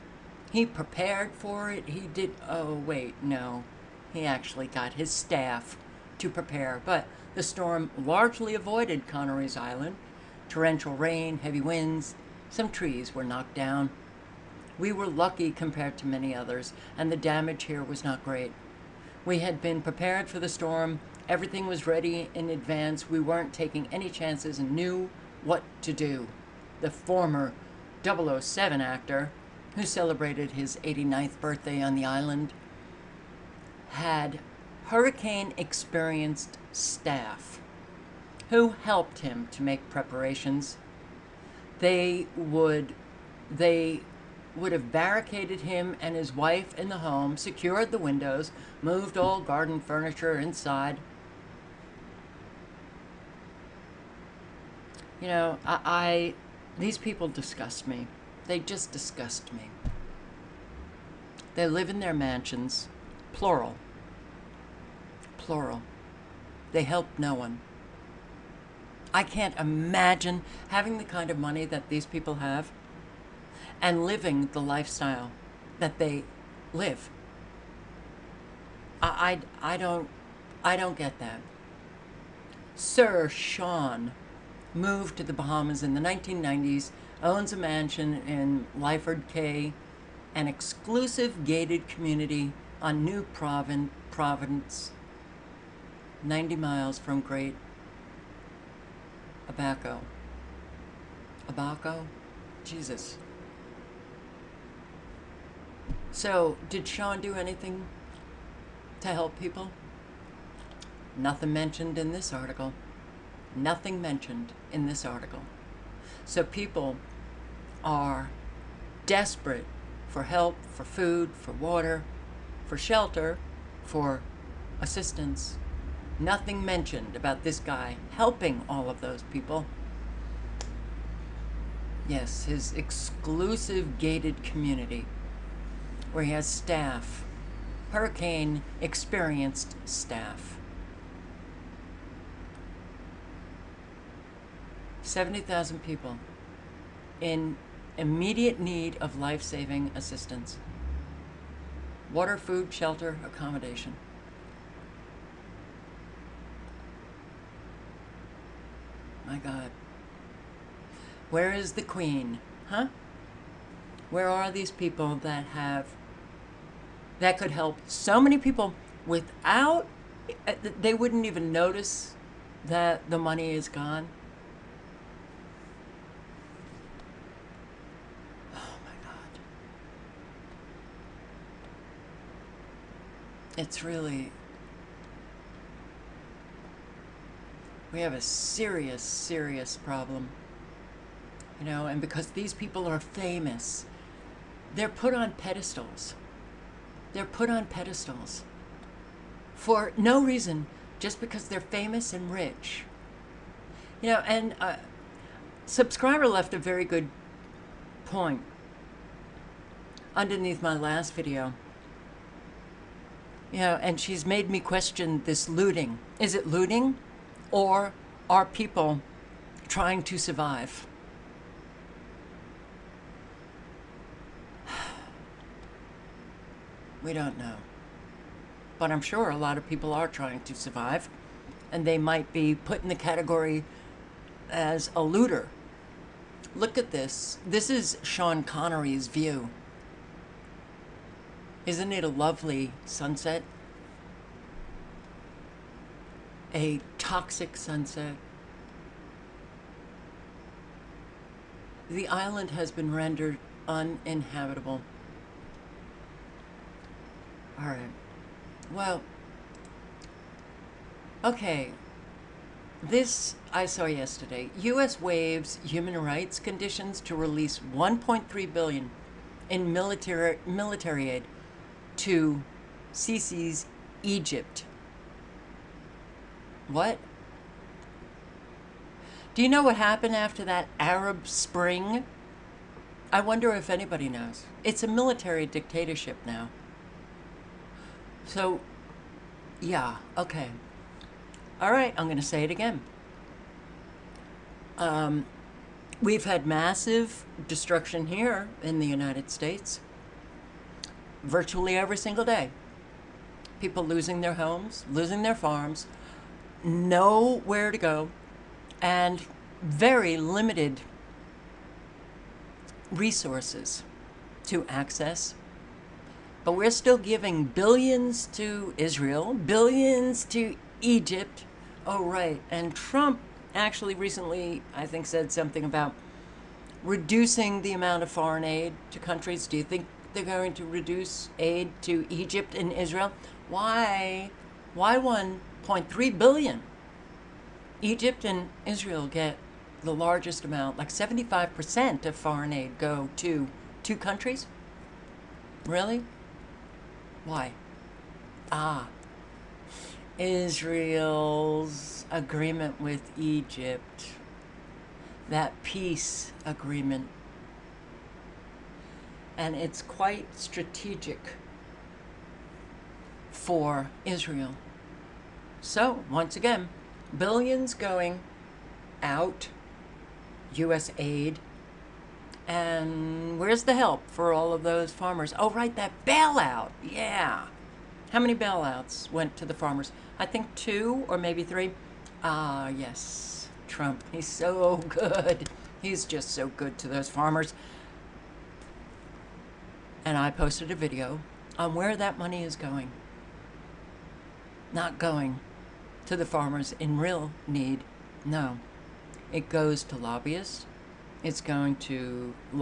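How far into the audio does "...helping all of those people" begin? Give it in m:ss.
2:08.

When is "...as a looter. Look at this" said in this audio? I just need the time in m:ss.
3:54.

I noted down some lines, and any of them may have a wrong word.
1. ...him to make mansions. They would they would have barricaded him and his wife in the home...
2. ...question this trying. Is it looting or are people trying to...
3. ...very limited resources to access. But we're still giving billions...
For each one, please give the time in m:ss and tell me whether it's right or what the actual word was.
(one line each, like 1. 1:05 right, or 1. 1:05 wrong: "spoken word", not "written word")
1. 0:39 wrong: "preparations", not "mansions"
2. 3:34 wrong: "looting", not "trying"
3. 5:09 right.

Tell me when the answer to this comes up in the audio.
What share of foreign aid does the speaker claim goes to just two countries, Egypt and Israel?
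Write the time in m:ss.
5:40.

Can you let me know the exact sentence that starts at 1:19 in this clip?
I, I, I don't I don't get that.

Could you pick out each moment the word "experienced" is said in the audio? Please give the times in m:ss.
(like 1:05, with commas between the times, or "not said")
0:35, 2:18.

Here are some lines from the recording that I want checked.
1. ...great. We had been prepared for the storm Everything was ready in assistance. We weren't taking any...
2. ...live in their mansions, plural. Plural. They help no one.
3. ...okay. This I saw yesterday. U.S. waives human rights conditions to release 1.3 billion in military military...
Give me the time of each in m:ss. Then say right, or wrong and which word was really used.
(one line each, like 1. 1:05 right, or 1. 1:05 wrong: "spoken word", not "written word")
1. 0:18 wrong: "advance", not "assistance"
2. 1:01 right
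3. 4:21 right.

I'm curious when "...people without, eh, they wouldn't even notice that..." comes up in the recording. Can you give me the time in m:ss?
2:48.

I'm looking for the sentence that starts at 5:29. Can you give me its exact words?
Do you think they're going to reduce aid to Egypt and Israel.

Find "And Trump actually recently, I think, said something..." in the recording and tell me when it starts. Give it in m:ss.
5:22.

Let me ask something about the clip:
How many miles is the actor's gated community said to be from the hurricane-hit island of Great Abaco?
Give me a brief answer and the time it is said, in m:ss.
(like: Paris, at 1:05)
90, at 1:36.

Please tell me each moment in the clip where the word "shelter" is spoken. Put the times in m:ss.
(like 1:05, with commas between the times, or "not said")
2:02, 2:32.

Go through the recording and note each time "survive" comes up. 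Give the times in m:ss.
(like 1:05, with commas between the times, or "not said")
3:40, 3:50.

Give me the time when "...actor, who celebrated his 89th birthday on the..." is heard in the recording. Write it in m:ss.
0:28.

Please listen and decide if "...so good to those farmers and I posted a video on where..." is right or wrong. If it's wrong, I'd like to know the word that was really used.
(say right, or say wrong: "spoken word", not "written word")
right.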